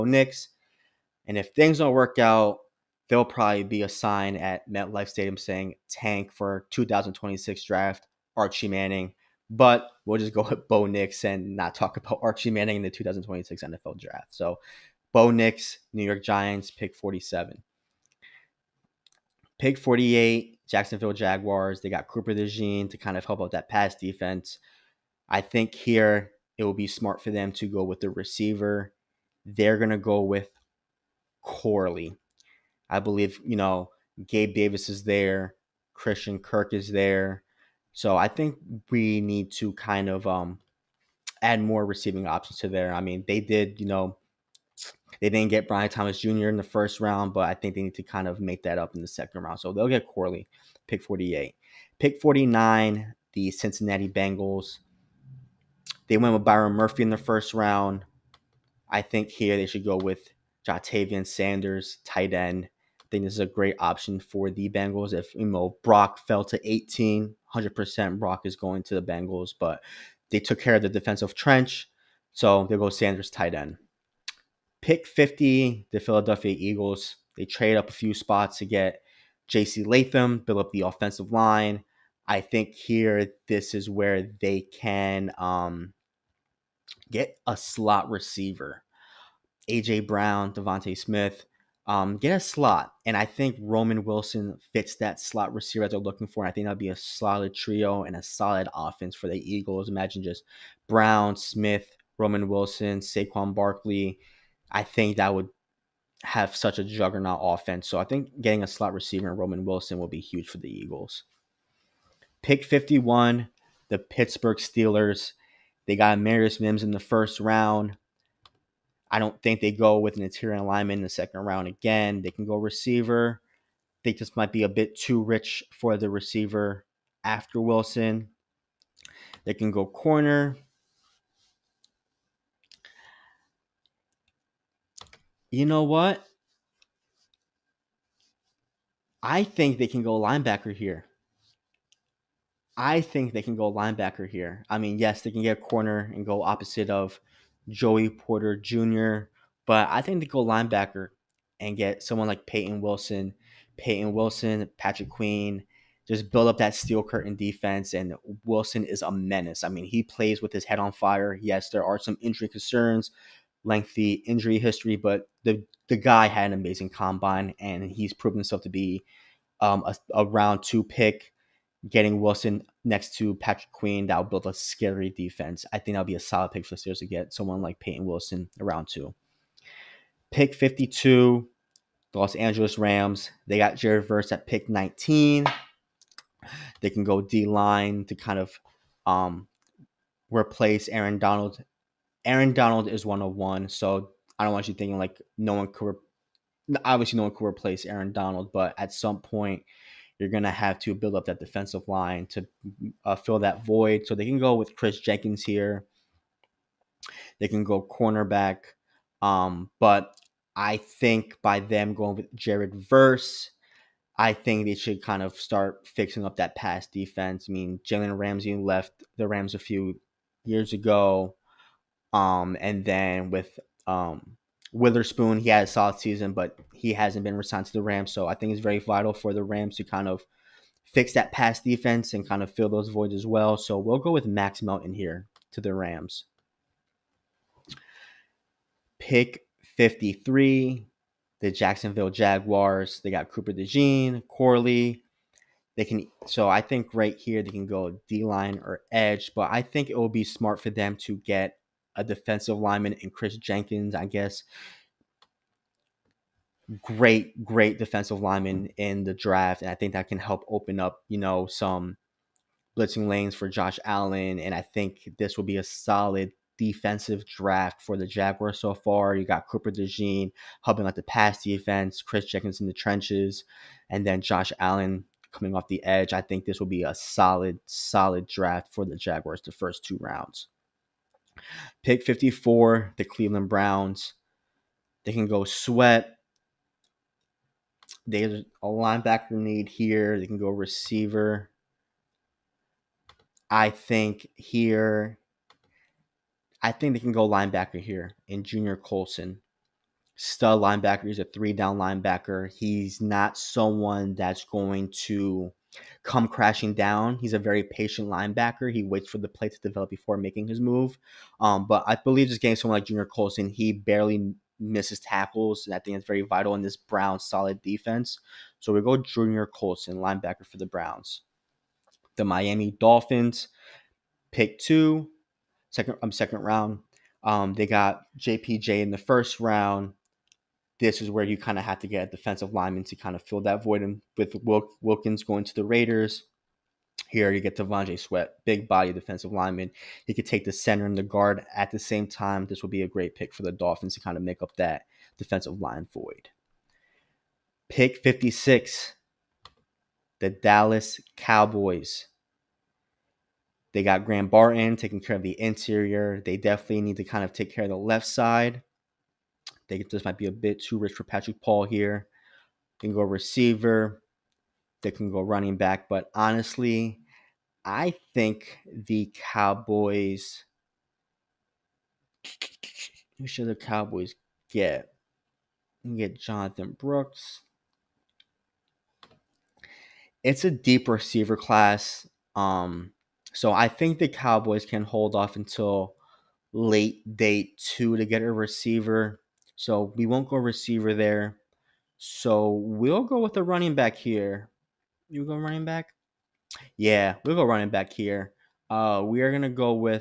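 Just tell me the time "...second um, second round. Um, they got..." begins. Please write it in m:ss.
5:25.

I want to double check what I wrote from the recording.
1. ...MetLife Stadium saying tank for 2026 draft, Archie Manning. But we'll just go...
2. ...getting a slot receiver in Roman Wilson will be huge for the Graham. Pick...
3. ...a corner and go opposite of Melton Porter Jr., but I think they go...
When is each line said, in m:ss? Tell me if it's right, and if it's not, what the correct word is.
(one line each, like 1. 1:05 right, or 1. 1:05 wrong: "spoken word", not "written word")
1. 0:04 right
2. 1:48 wrong: "Eagles", not "Graham"
3. 2:25 wrong: "Joey", not "Melton".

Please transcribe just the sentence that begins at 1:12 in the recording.
So they goes Sanders tight end.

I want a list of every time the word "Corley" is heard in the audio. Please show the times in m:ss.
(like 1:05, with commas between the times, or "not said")
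0:31, 0:50, 4:04.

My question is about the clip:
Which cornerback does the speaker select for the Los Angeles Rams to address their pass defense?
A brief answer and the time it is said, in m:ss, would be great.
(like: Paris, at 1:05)
Max Melton, at 3:54.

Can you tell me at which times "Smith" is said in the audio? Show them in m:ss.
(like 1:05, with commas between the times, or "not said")
1:30, 1:41.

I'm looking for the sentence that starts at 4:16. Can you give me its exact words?
Great, great defensive lineman in the draft.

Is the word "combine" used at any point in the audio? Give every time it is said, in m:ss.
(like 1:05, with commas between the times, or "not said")
2:46.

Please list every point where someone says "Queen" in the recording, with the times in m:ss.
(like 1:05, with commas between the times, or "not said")
2:35, 2:53.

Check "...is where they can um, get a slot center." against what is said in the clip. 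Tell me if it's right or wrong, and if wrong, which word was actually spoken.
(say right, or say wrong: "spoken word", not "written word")
wrong: "receiver", not "center".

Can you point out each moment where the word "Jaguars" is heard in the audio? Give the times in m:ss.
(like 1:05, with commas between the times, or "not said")
0:21, 4:02, 4:28, 4:38.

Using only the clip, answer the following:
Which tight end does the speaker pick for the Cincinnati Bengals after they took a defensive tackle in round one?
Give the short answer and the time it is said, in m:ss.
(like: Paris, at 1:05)
Ja'Tavion Sanders, at 1:00.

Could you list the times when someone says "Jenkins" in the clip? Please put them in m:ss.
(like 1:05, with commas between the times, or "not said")
3:24, 4:13, 4:32.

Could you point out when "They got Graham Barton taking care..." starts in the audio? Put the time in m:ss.
5:53.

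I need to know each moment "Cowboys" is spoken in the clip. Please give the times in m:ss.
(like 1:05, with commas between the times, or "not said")
5:51, 6:09, 6:13, 6:24.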